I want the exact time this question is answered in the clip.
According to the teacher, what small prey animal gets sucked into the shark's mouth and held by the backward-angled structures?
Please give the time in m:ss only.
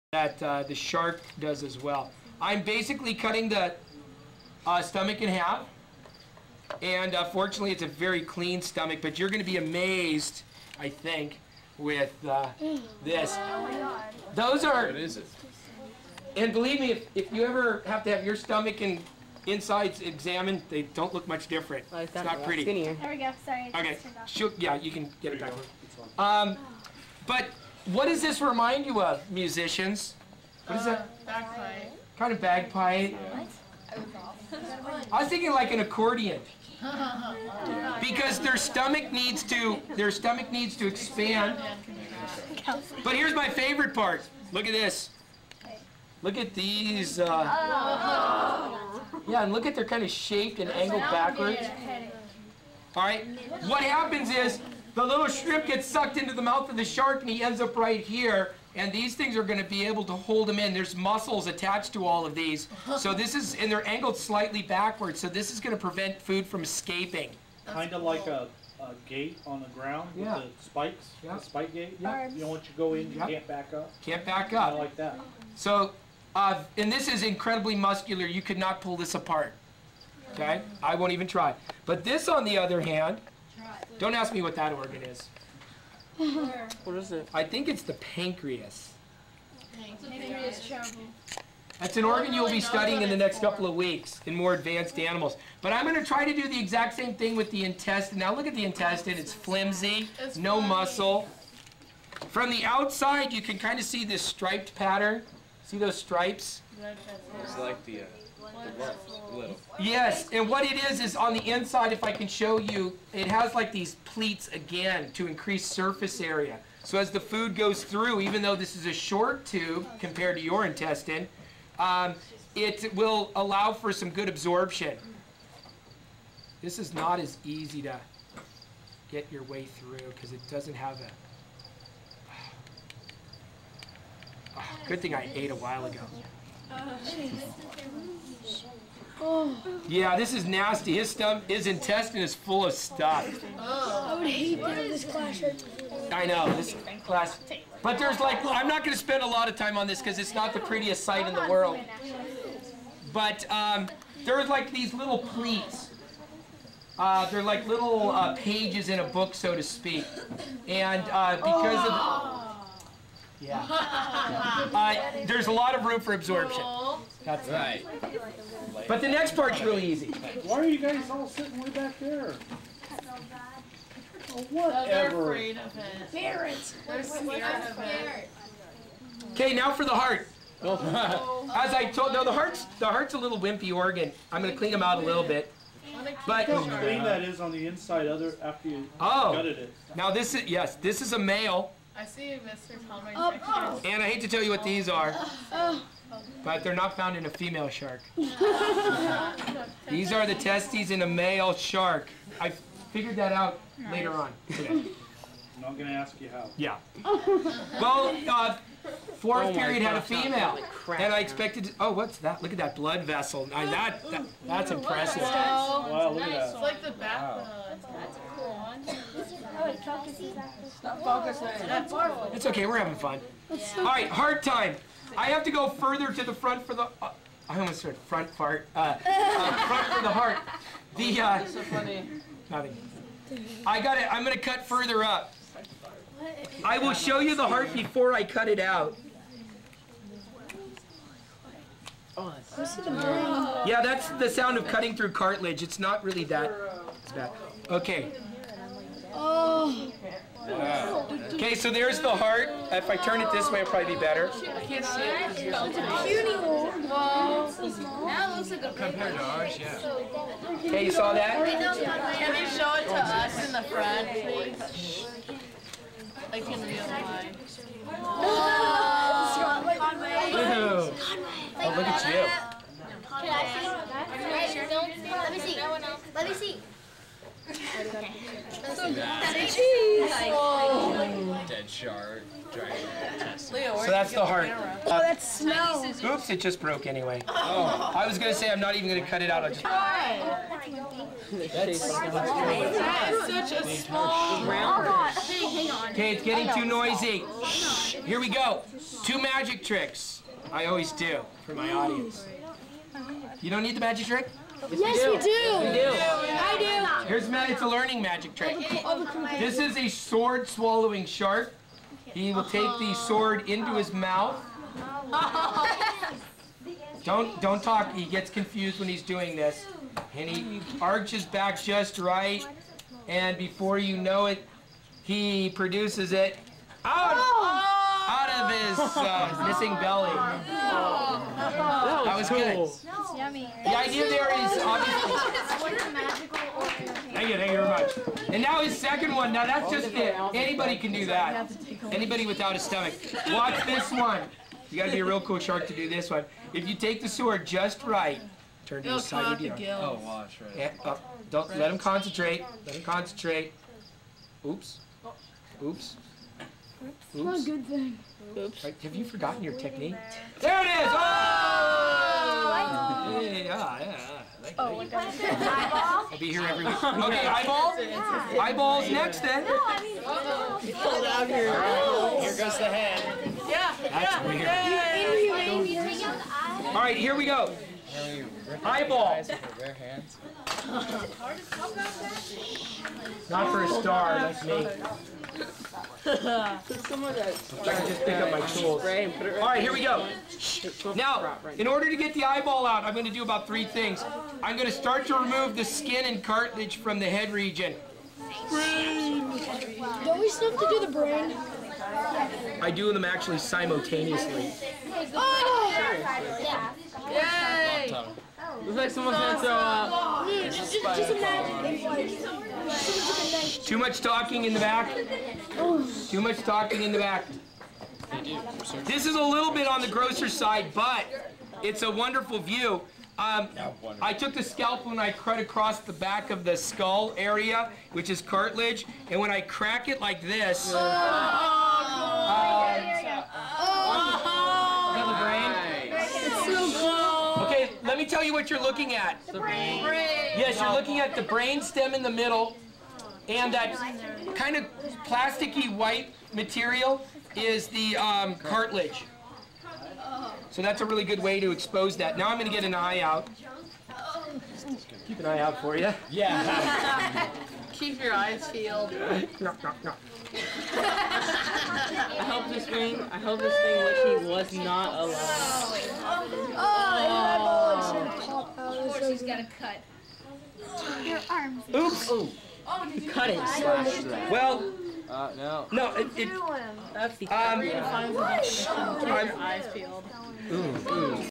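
0:55.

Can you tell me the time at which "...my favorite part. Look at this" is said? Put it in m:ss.
0:43.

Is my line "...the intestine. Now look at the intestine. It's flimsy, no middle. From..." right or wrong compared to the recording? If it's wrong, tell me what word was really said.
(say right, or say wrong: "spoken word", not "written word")
wrong: "muscle", not "middle".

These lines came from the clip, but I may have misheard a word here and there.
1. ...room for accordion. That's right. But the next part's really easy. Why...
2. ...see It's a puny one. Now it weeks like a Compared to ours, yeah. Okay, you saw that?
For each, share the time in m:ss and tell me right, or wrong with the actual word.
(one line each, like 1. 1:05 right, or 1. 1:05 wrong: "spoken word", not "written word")
1. 2:45 wrong: "absorption", not "accordion"
2. 4:14 wrong: "looks", not "weeks".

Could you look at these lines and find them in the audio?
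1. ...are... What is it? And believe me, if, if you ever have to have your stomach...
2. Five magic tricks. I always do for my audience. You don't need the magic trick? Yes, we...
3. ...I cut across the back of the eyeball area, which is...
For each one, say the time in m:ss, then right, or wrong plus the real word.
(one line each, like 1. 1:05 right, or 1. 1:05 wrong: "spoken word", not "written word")
1. 0:14 right
2. 4:59 wrong: "Two", not "Five"
3. 7:04 wrong: "skull", not "eyeball".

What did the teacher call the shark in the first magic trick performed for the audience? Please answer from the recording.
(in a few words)
Sword swallowing shark.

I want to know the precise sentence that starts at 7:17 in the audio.
let me tell you what you're looking at.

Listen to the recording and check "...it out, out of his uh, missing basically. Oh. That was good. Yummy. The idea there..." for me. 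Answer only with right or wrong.
wrong.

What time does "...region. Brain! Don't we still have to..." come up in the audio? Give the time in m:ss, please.
6:37.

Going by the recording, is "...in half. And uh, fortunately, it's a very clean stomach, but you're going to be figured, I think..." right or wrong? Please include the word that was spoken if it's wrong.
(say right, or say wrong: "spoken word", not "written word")
wrong: "amazed", not "figured".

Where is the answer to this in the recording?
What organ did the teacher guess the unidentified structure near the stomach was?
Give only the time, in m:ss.
1:27.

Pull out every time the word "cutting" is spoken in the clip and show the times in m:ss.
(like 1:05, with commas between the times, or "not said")
0:03, 4:04.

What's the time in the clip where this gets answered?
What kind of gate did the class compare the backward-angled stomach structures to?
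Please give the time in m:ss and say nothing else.
1:11.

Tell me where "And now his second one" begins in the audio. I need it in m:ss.
5:38.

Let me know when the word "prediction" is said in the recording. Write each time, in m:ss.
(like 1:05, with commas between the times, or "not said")
not said.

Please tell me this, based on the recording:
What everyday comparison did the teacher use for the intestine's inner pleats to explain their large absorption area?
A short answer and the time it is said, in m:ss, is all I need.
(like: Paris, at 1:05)
Pages in a book, at 2:38.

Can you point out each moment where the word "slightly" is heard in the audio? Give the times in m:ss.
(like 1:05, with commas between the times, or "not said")
1:04.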